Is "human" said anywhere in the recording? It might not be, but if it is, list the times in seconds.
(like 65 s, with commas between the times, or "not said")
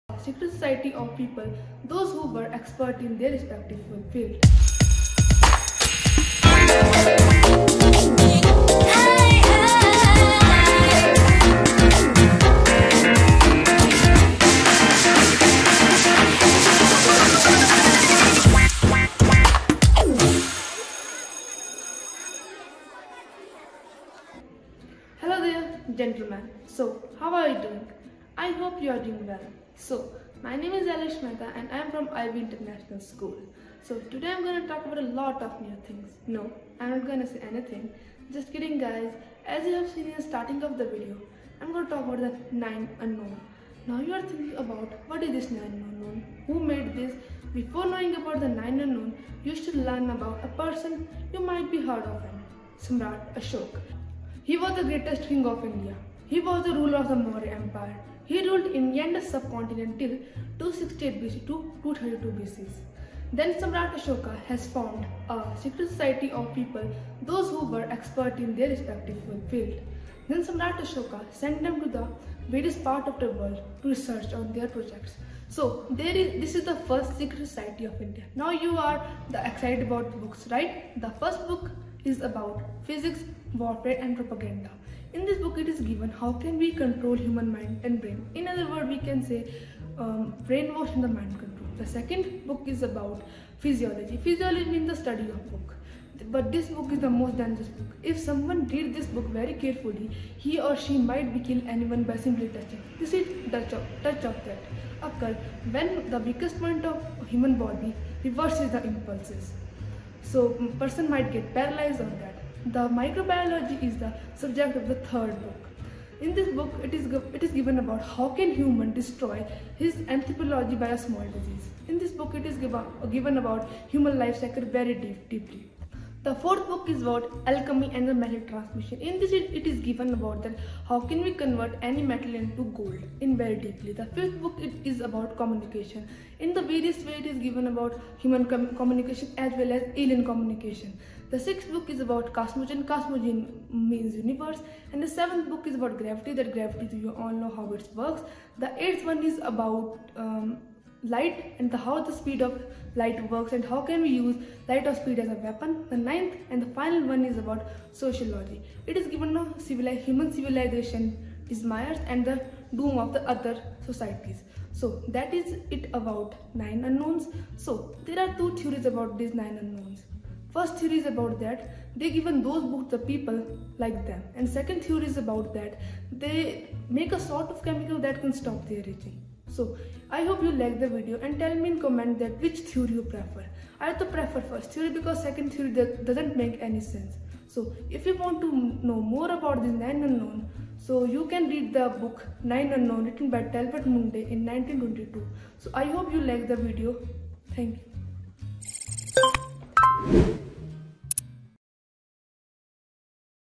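87 s, 107 s, 118 s, 123 s, 138 s, 159 s.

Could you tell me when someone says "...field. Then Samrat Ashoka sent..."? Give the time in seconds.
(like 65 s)
69 s.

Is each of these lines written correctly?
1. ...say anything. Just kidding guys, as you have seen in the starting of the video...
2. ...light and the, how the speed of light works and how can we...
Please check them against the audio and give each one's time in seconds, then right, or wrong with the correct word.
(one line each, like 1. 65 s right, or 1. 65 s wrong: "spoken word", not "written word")
1. 37 s right
2. 151 s right.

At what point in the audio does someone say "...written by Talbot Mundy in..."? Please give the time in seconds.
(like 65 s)
193 s.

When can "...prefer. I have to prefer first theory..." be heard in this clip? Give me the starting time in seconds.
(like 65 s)
183 s.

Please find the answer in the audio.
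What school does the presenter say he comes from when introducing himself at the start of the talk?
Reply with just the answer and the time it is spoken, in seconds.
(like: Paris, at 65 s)
IB International School, at 32 s.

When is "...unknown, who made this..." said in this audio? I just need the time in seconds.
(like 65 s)
45 s.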